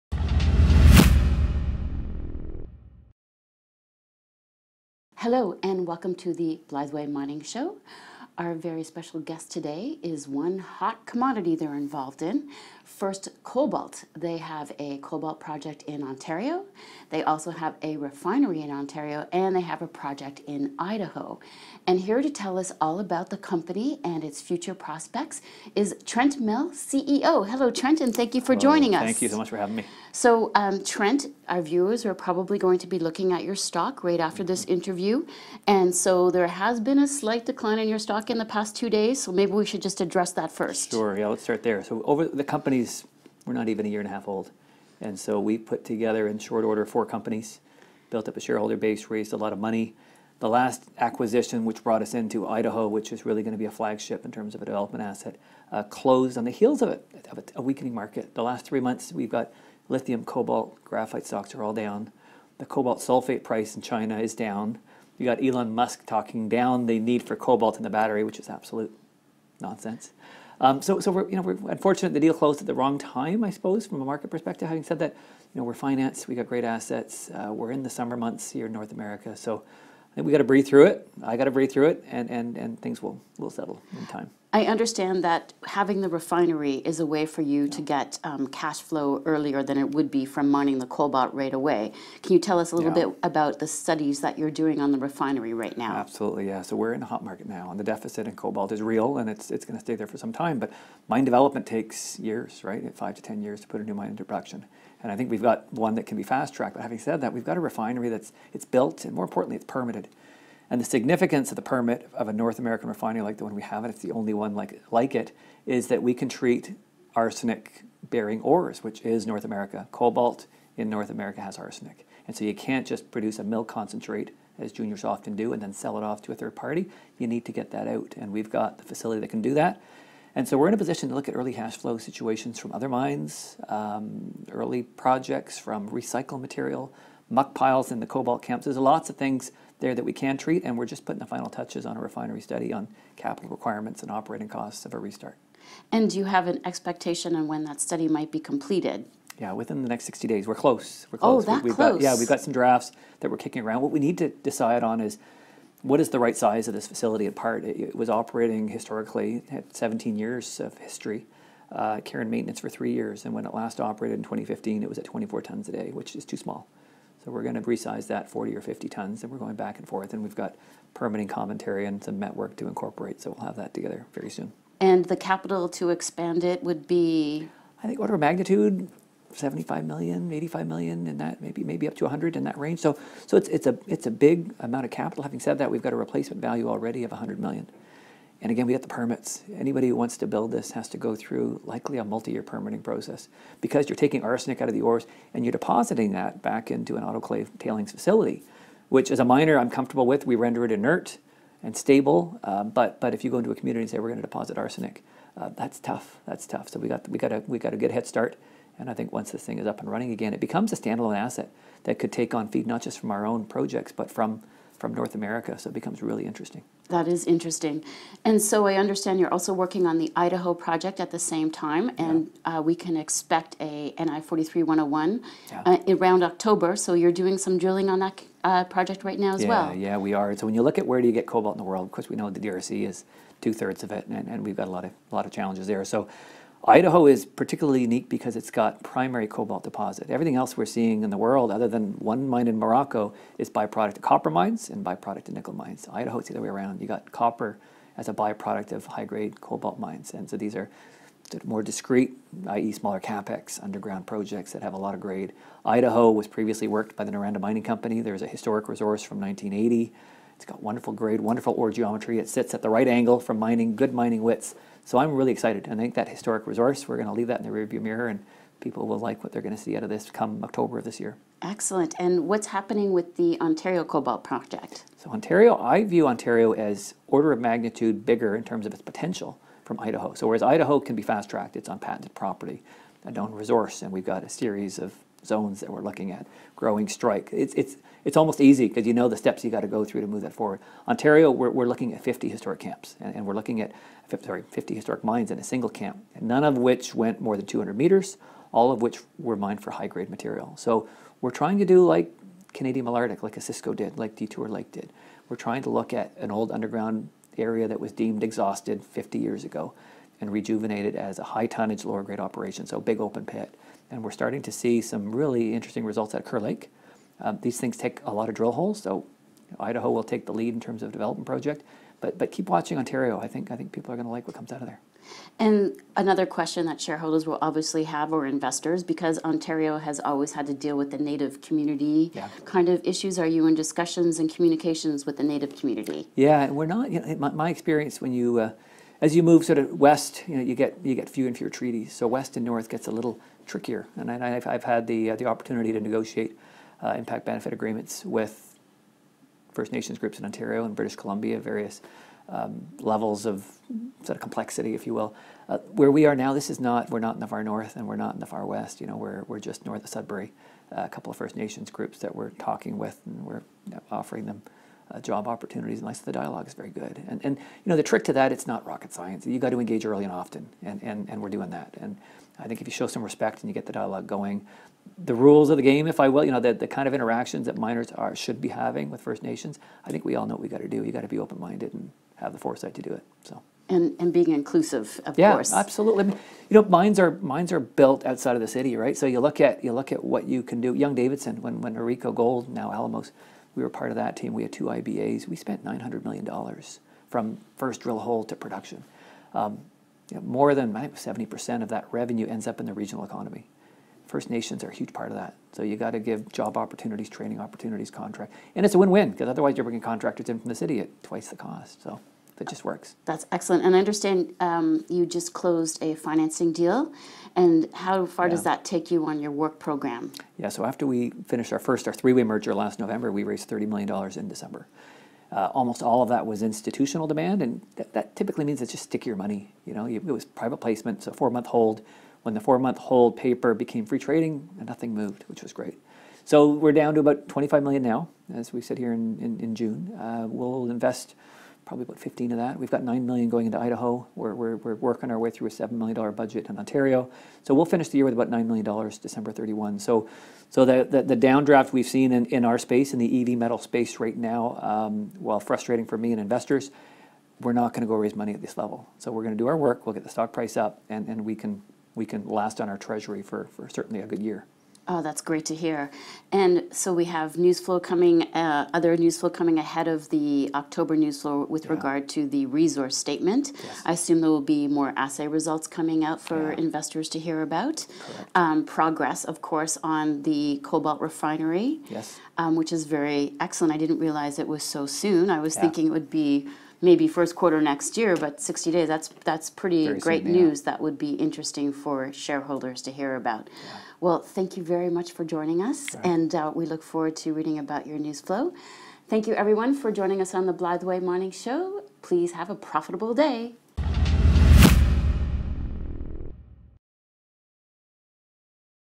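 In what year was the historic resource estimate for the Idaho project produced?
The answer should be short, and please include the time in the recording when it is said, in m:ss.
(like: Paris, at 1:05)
1980, at 4:19.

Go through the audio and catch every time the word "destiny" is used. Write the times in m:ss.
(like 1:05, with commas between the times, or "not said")
not said.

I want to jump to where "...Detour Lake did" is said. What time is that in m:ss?
5:04.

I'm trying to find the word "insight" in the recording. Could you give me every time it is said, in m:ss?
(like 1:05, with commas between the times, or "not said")
not said.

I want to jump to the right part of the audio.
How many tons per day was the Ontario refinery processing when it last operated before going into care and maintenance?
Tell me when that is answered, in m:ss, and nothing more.
2:45.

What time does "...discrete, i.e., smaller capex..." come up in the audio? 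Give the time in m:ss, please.
4:11.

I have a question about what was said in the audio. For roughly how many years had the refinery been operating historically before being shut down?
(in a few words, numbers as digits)
17 years.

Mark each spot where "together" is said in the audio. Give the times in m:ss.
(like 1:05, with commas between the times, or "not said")
0:45, 2:53.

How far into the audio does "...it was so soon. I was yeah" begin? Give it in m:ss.
8:04.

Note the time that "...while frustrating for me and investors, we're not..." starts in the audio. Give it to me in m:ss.
7:35.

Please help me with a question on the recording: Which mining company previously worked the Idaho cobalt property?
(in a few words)
Noranda Mining Company.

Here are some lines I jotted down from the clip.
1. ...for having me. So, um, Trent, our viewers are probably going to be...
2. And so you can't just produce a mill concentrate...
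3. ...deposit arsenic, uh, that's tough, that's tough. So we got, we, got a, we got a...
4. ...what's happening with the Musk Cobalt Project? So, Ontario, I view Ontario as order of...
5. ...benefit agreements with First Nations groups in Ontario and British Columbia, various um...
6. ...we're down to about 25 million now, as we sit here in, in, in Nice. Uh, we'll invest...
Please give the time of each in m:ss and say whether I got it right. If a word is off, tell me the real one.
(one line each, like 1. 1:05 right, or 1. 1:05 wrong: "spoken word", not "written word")
1. 0:29 right
2. 2:02 right
3. 3:24 right
4. 4:32 wrong: "Ontario", not "Musk"
5. 5:47 right
6. 7:16 wrong: "June", not "Nice".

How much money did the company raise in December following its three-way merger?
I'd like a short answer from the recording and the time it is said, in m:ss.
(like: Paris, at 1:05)
$30 million, at 7:03.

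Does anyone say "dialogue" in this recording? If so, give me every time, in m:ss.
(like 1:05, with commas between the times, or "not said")
6:06, 6:13.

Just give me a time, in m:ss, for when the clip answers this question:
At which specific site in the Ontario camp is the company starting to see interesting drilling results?
5:16.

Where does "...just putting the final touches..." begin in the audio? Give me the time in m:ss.
2:20.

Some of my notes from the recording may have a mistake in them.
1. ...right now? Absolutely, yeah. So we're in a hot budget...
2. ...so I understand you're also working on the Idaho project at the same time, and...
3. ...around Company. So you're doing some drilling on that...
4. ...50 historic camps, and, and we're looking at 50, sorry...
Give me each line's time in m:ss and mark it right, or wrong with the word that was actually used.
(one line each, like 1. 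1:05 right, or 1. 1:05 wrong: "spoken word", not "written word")
1. 1:35 wrong: "market", not "budget"
2. 3:38 right
3. 3:45 wrong: "October", not "Company"
4. 4:52 right.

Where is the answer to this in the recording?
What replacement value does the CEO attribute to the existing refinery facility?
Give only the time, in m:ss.
3:05.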